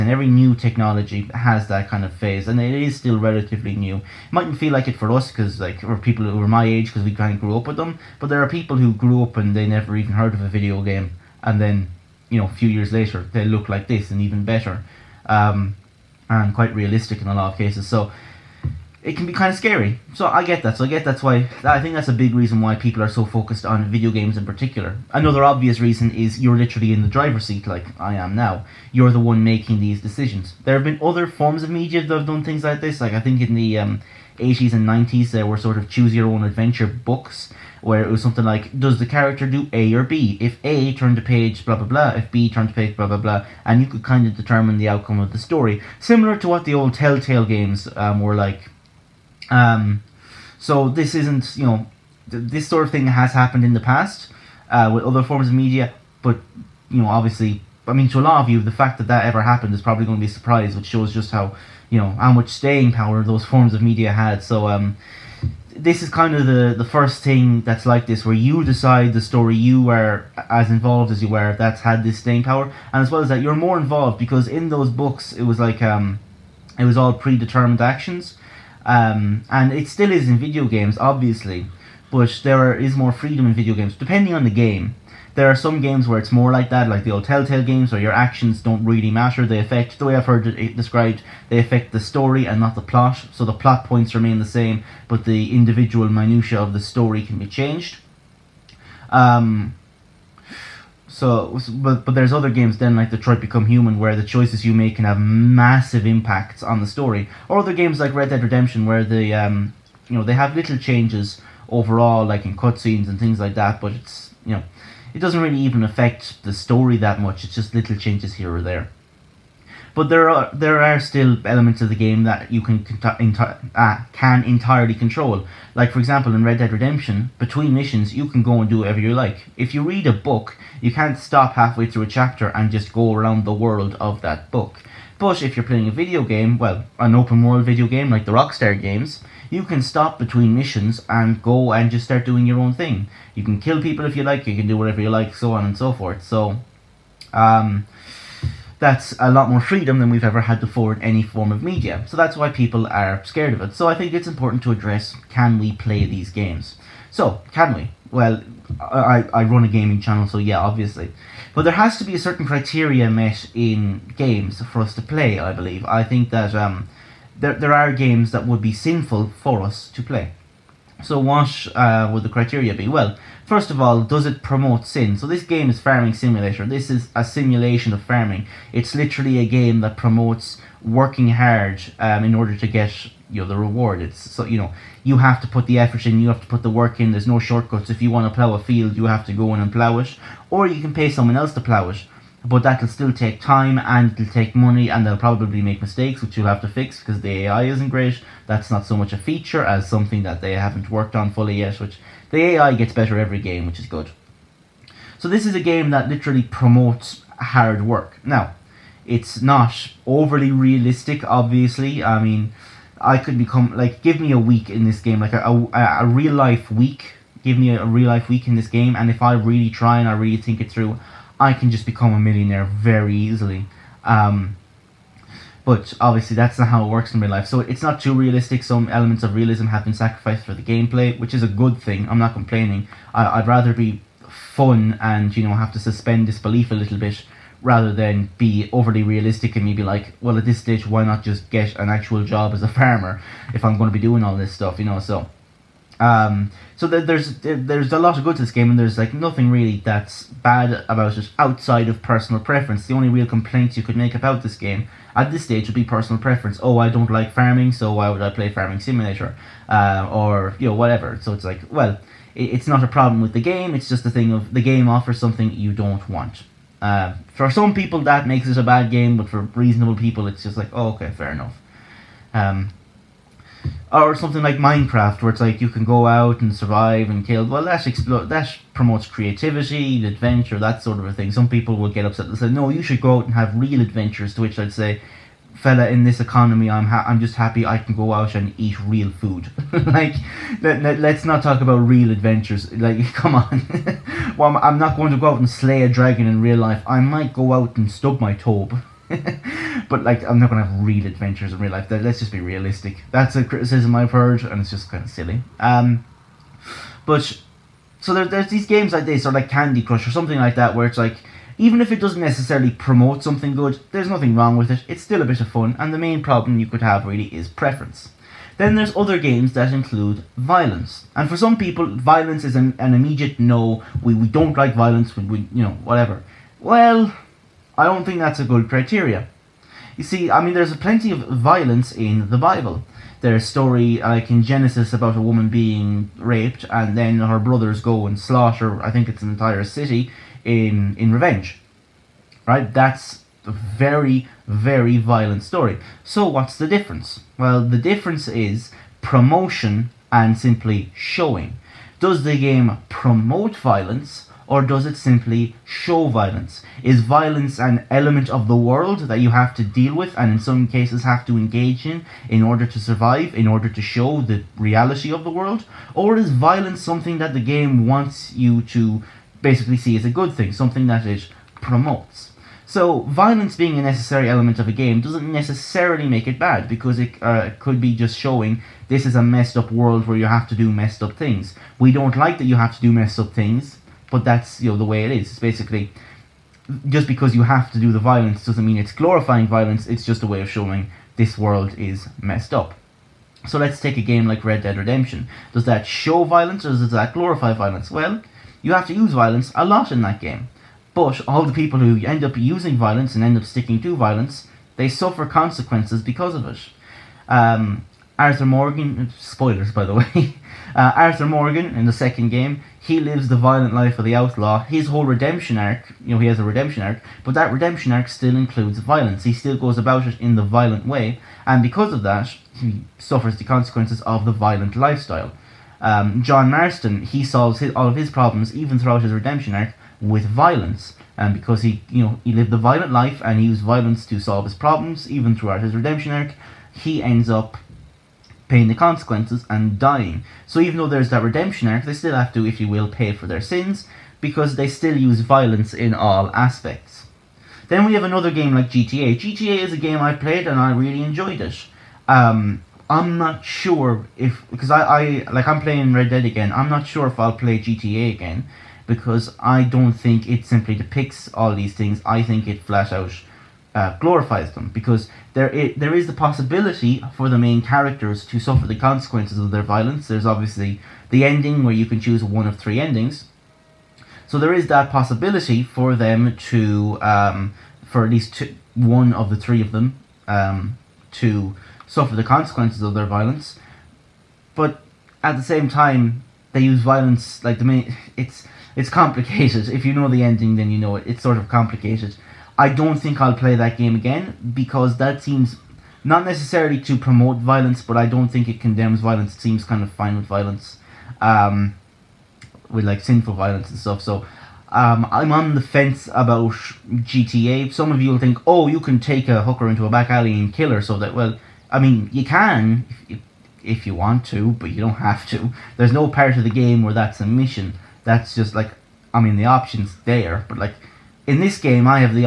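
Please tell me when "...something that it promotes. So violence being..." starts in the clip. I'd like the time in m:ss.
6:10.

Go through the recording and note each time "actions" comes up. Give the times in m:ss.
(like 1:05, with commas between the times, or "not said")
1:17, 1:28.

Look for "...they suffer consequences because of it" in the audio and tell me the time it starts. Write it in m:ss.
6:44.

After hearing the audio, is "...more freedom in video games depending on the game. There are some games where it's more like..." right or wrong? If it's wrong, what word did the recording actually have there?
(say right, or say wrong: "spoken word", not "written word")
right.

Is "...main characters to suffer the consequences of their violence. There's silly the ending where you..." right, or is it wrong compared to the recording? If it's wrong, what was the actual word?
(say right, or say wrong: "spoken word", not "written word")
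wrong: "obviously", not "silly".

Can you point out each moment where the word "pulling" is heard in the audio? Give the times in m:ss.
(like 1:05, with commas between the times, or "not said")
not said.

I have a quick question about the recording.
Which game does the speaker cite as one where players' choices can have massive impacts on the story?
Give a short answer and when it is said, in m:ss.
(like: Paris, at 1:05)
Detroit Become Human, at 1:43.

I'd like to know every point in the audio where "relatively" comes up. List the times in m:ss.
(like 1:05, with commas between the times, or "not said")
0:03.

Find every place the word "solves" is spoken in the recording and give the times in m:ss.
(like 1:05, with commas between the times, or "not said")
7:07, 7:14.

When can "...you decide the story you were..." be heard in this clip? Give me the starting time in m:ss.
1:08.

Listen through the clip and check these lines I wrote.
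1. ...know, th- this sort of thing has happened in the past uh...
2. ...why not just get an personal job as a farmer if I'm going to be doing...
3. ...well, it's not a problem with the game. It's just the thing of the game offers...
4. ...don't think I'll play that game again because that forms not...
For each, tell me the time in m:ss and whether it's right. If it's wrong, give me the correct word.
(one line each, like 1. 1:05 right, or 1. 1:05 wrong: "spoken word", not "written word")
1. 0:51 right
2. 4:00 wrong: "actual", not "personal"
3. 4:21 right
4. 8:12 wrong: "seems", not "forms".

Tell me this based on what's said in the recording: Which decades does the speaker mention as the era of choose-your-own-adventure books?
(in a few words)
80s and 90s.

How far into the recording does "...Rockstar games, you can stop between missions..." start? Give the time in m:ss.
2:18.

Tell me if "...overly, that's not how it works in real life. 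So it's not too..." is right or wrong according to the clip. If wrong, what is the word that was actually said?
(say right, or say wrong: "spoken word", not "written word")
wrong: "obviously", not "overly".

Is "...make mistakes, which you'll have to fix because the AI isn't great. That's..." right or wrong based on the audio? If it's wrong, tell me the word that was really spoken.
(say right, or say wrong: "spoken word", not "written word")
right.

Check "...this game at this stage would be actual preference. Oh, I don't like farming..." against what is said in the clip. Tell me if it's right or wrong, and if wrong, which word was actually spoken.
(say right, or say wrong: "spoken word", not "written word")
wrong: "personal", not "actual".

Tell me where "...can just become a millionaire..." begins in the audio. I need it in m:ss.
3:41.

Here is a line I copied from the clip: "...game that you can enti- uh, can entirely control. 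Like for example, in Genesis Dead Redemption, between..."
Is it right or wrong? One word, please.
wrong.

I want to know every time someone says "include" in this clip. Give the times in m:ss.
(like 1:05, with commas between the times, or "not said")
5:19, 6:58.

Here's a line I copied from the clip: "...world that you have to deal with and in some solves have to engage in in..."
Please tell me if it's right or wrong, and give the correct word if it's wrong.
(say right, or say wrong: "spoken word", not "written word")
wrong: "cases", not "solves".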